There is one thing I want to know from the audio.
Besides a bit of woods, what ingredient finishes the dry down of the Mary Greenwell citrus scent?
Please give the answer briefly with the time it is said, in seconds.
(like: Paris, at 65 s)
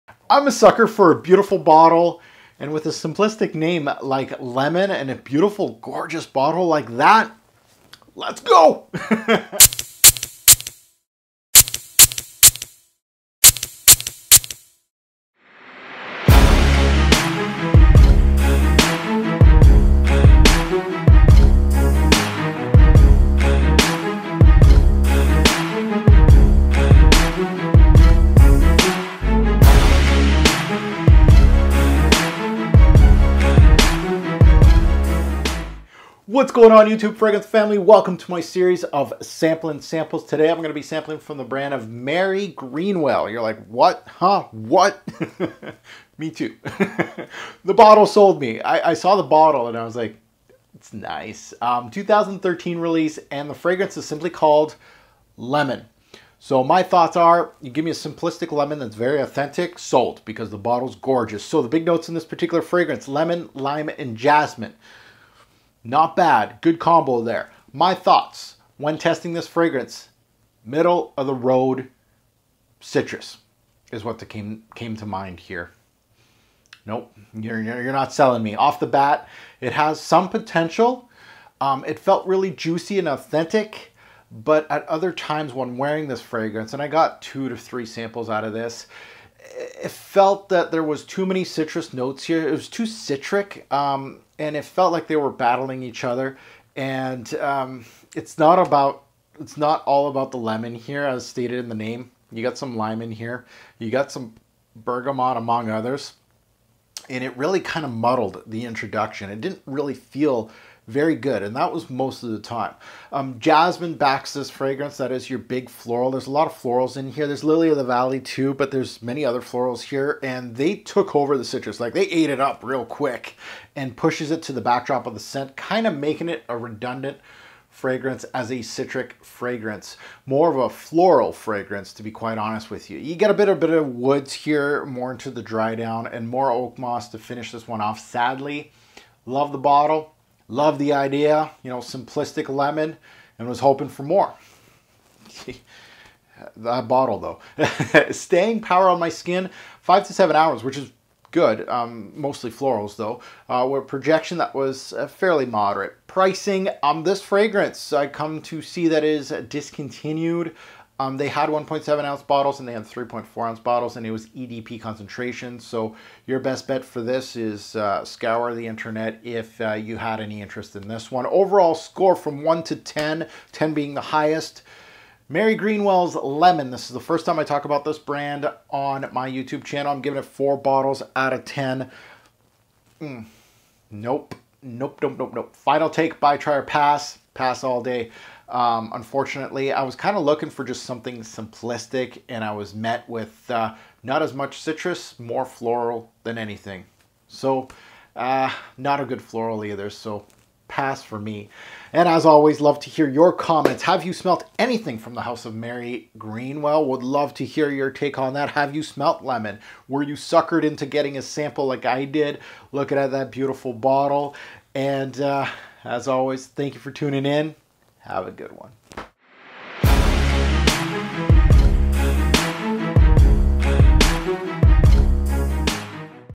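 Oak moss, at 136 s.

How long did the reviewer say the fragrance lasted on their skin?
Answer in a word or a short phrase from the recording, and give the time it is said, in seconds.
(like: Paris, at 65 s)
5 to 7 hours, at 149 s.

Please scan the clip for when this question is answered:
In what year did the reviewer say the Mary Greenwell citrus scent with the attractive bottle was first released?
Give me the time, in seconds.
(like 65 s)
51 s.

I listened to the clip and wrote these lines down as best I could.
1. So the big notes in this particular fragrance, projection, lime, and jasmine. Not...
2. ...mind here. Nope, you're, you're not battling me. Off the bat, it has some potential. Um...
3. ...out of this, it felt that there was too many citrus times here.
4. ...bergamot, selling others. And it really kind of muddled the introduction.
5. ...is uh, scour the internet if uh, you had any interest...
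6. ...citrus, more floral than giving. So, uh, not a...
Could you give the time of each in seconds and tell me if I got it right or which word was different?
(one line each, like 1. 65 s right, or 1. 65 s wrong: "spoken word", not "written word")
1. 61 s wrong: "lemon", not "projection"
2. 75 s wrong: "selling", not "battling"
3. 88 s wrong: "notes", not "times"
4. 104 s wrong: "among", not "selling"
5. 167 s right
6. 194 s wrong: "anything", not "giving".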